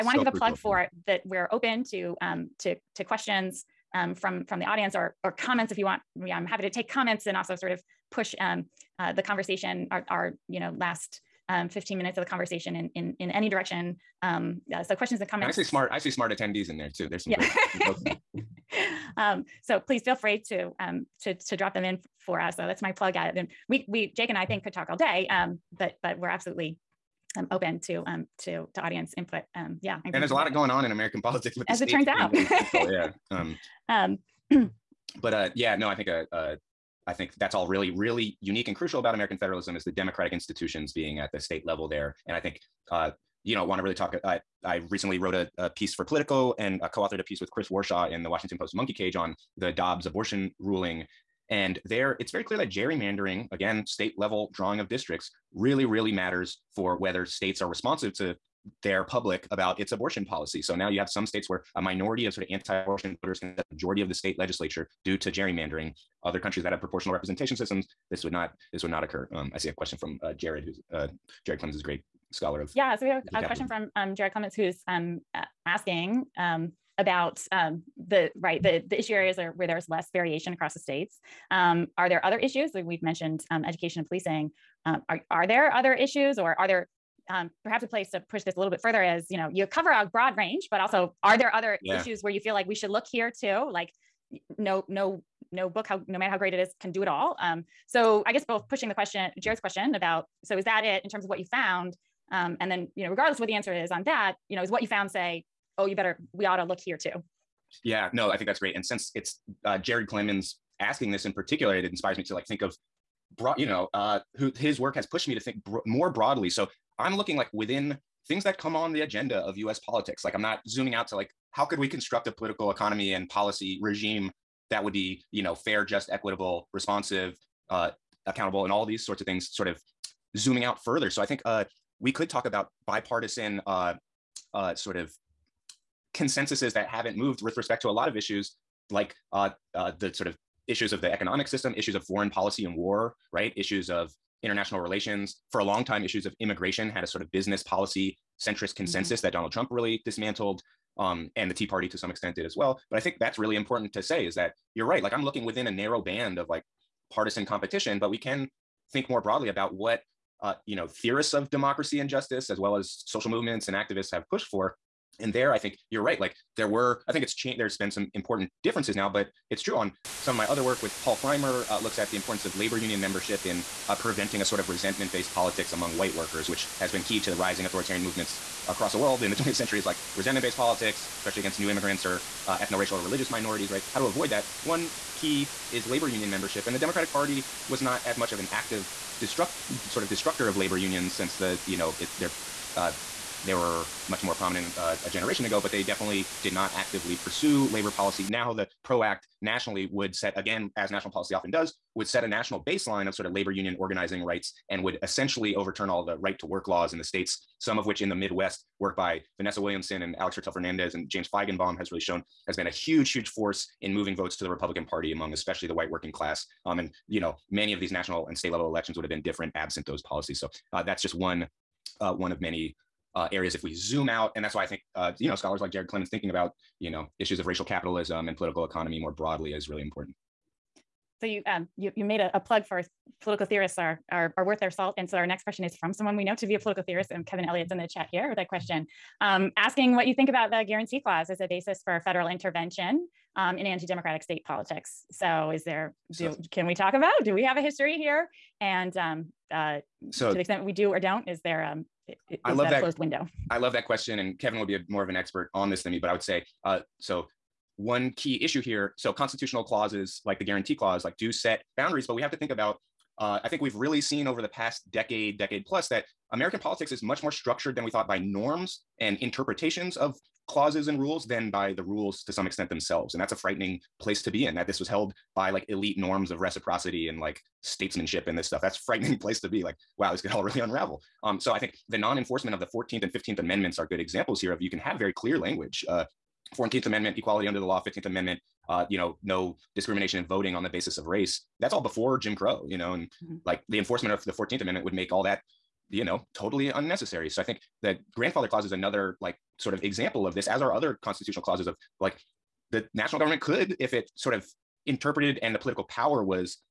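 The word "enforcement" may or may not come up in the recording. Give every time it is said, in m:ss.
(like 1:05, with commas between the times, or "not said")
4:41, 4:53.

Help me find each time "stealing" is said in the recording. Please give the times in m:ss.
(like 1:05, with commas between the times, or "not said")
not said.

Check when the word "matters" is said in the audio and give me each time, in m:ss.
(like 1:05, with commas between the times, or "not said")
0:56, 1:36.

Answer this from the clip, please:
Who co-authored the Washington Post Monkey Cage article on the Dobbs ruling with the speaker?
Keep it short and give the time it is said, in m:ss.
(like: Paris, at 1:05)
Chris Warshaw, at 0:47.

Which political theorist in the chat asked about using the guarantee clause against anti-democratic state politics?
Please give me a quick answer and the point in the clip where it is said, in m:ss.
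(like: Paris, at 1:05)
Kevin Elliott, at 3:57.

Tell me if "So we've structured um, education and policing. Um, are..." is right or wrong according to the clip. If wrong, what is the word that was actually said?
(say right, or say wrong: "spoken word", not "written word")
wrong: "mentioned", not "structured".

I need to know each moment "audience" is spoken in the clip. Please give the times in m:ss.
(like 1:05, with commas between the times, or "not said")
0:04, 0:28.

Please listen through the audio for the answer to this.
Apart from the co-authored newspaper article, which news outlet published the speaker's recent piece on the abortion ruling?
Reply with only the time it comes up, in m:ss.
0:46.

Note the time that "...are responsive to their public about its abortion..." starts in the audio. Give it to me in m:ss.
0:57.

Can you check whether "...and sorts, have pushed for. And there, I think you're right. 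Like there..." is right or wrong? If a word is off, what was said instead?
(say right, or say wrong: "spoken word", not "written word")
wrong: "activists", not "sorts".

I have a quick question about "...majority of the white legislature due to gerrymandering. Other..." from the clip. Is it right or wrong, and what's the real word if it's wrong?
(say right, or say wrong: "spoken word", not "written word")
wrong: "state", not "white".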